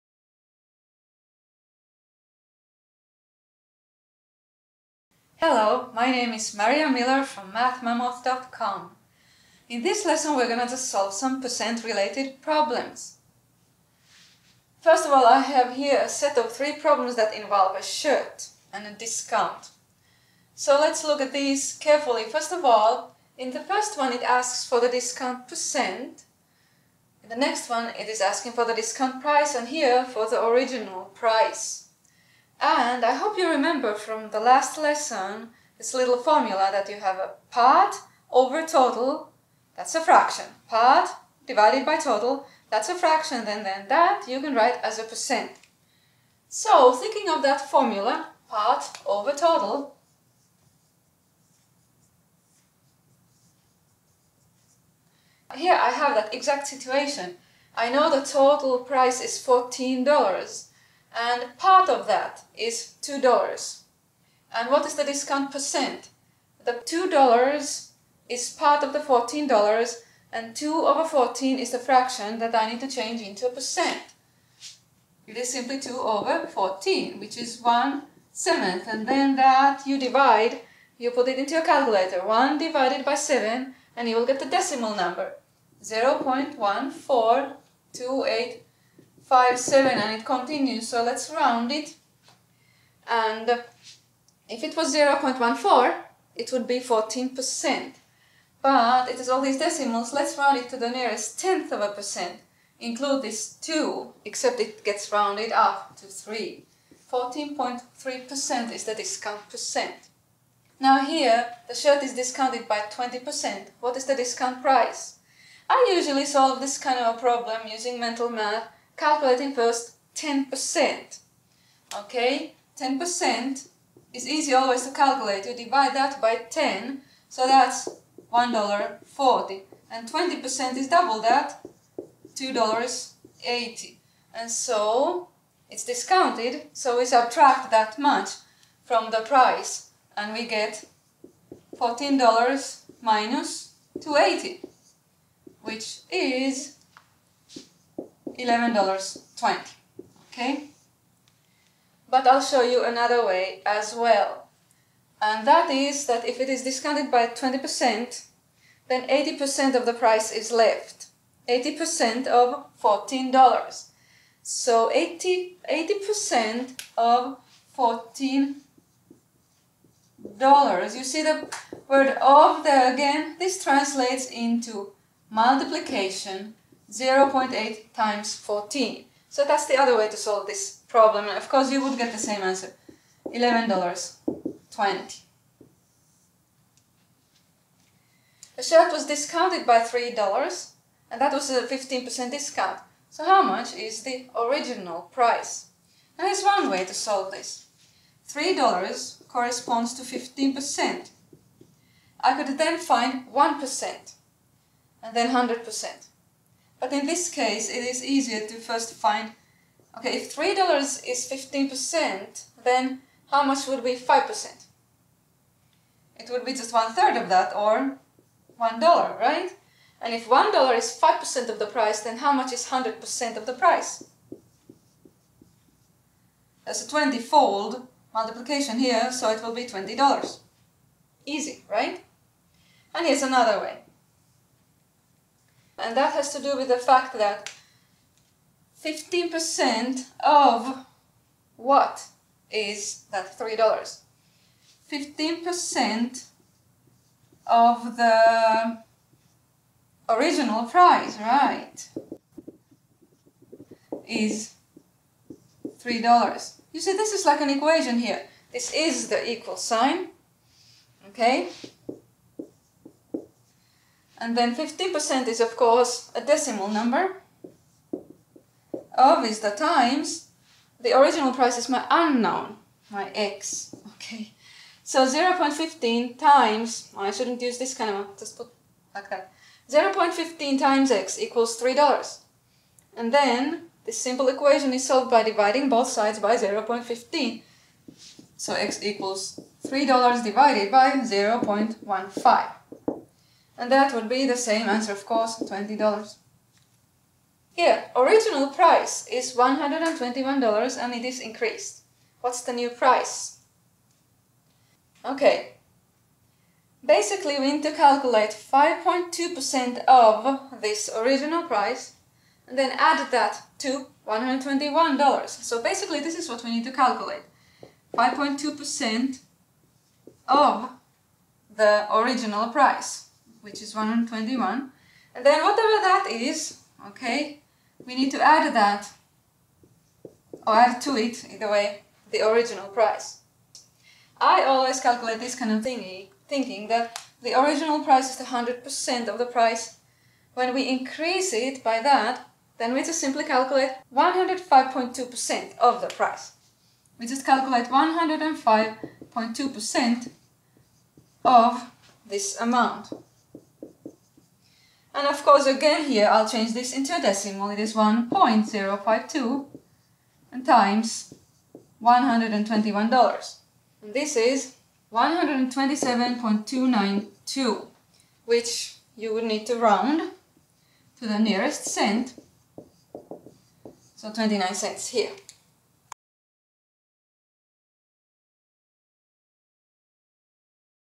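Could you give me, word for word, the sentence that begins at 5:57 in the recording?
It is 1.052 and times $121.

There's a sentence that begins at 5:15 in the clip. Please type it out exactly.
So basically, this is what we need to calculate.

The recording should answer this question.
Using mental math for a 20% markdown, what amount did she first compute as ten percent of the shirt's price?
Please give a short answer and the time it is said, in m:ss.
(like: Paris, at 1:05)
$1.40, at 2:08.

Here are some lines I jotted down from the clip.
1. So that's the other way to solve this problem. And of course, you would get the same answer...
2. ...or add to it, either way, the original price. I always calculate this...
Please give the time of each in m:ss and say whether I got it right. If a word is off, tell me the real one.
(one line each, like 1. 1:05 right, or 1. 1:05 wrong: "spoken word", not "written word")
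1. 2:59 right
2. 5:30 right.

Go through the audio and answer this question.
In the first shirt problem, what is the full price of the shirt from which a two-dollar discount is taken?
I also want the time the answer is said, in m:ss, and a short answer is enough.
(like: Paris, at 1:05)
$14, at 0:58.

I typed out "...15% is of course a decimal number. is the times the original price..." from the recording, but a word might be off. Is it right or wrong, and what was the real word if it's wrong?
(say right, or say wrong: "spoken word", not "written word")
right.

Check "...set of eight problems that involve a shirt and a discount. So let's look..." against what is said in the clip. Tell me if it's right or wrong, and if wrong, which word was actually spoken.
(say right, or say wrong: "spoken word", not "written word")
wrong: "three", not "eight".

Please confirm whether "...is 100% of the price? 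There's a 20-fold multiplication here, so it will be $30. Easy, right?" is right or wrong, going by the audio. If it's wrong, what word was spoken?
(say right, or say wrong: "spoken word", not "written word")
wrong: "20", not "30".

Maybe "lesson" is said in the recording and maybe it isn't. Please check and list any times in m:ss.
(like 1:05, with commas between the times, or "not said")
0:10, 0:34.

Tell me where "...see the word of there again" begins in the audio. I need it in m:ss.
2:51.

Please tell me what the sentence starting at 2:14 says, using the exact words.
And so it's discounted, so we subtract that much from the price and we get $14 minus 280 which is $11.20.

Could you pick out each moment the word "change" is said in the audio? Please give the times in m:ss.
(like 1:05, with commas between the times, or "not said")
1:12, 5:56.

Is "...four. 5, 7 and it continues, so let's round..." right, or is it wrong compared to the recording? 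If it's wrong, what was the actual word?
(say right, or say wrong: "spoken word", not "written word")
wrong: "eight", not "four".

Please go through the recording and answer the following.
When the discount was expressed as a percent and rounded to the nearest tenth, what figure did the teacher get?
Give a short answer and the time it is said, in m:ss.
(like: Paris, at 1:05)
14.3%, at 1:47.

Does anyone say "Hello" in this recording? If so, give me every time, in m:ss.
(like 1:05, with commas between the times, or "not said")
0:05.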